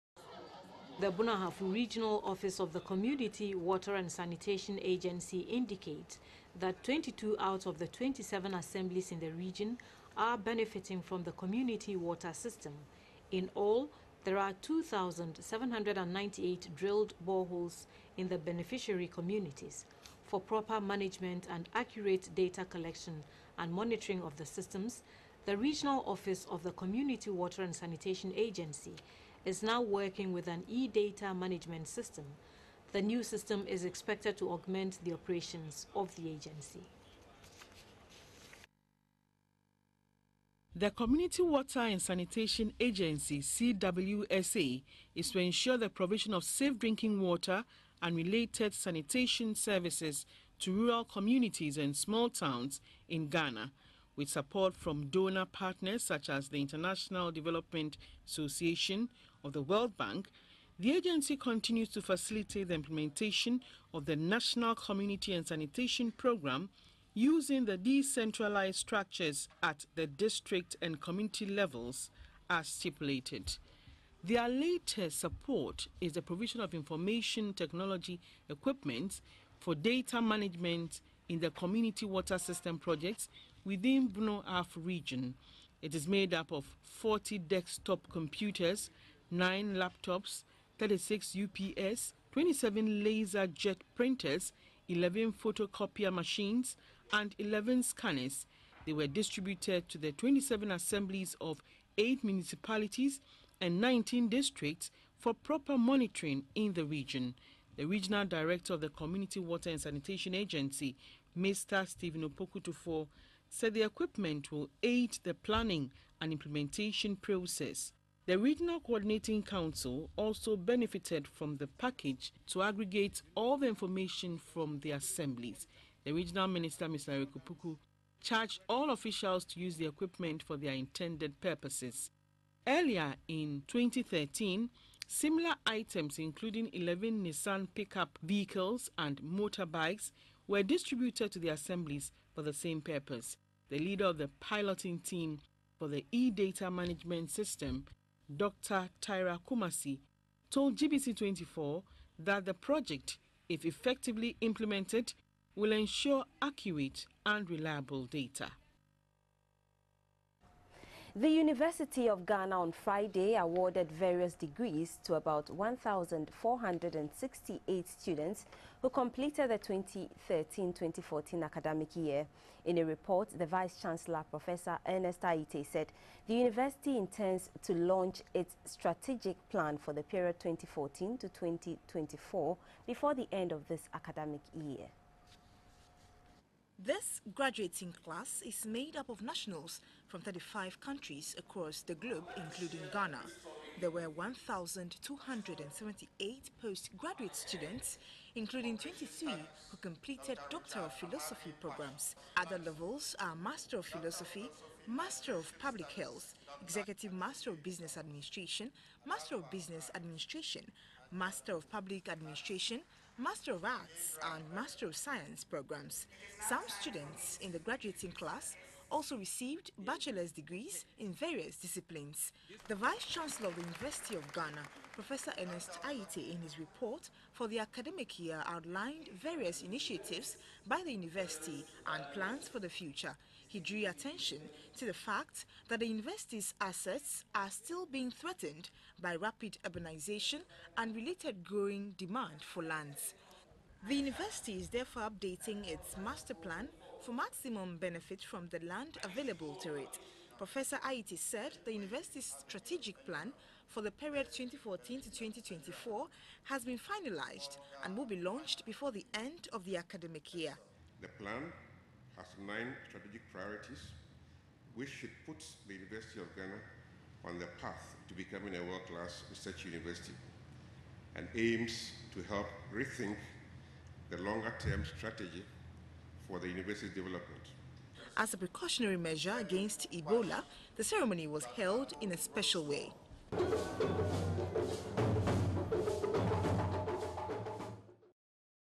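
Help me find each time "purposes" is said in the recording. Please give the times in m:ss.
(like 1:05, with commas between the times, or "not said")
2:11, 2:22.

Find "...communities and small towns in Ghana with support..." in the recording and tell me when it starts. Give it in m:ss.
0:51.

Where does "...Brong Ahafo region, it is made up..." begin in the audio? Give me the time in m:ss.
1:24.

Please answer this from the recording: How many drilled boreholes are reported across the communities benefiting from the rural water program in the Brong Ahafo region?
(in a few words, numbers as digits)
2,798.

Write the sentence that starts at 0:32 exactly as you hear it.
The new system is expected to augment the operations of the agency.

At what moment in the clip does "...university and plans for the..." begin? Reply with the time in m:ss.
3:50.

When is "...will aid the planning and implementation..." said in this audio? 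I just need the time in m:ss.
1:54.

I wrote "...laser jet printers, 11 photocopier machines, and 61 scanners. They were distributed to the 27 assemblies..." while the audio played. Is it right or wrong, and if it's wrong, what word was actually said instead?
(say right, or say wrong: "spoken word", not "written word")
wrong: "11", not "61".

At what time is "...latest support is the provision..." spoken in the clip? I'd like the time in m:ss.
1:14.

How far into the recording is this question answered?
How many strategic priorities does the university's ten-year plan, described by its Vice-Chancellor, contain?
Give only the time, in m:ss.
4:22.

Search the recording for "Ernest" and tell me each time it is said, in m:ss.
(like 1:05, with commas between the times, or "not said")
2:54, 3:45.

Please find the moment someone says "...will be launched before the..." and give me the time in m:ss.
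4:17.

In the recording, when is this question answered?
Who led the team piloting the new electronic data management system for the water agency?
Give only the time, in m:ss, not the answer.
2:28.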